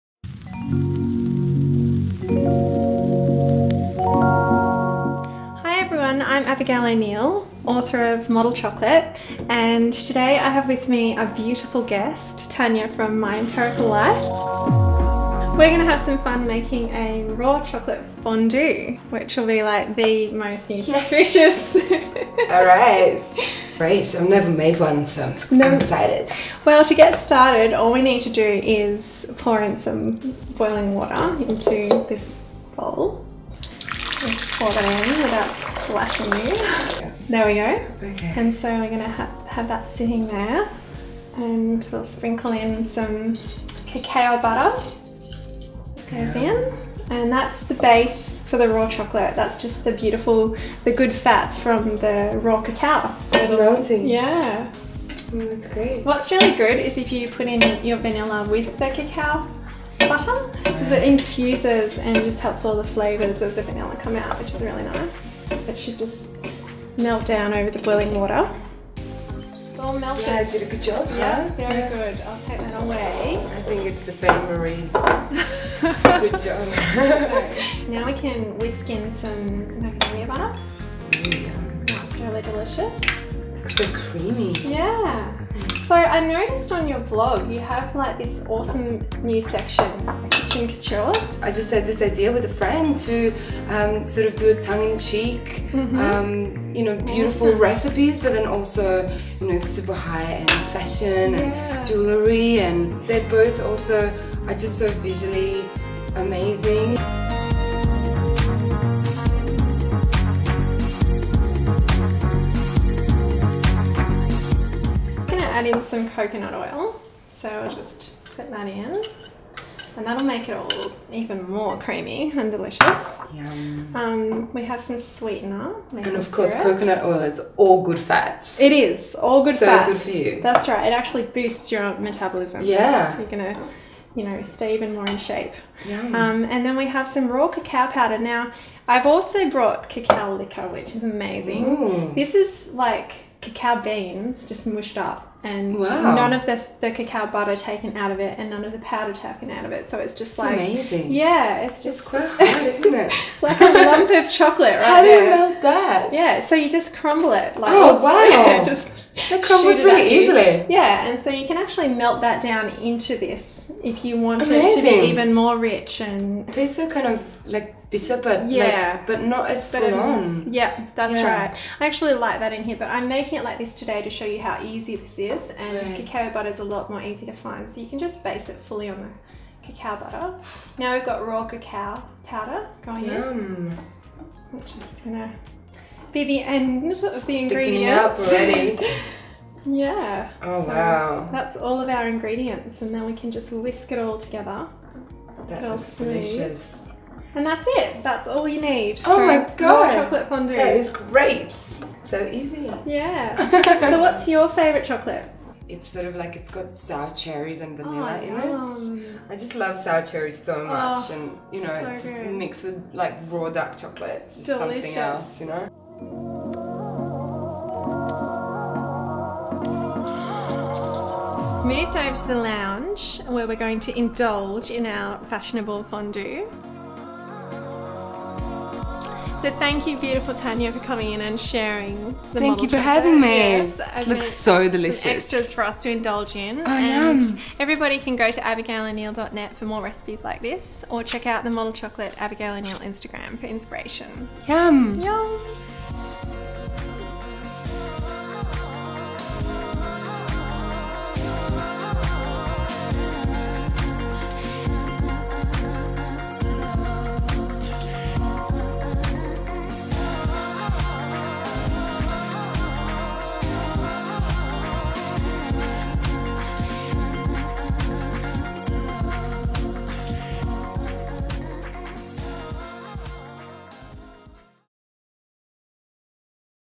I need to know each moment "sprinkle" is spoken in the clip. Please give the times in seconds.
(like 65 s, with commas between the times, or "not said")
42 s.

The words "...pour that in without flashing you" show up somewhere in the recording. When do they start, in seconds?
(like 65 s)
34 s.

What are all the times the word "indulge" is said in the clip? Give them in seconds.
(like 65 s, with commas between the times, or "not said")
223 s, 235 s.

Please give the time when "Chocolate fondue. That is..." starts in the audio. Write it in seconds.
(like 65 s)
200 s.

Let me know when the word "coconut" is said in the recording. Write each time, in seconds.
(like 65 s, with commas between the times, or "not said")
116 s, 126 s.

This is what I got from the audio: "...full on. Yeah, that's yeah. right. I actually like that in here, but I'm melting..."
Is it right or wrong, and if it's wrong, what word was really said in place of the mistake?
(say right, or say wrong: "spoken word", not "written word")
wrong: "making", not "melting".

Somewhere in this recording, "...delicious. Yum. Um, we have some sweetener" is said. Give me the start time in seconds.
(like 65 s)
122 s.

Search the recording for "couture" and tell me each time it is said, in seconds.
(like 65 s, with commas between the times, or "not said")
90 s.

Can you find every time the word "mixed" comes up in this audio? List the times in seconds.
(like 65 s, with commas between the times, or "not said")
212 s.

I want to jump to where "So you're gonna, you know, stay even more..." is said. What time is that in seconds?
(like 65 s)
133 s.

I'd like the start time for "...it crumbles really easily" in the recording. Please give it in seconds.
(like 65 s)
159 s.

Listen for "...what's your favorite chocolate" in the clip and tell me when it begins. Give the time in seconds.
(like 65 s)
204 s.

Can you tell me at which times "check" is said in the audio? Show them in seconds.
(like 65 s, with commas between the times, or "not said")
241 s.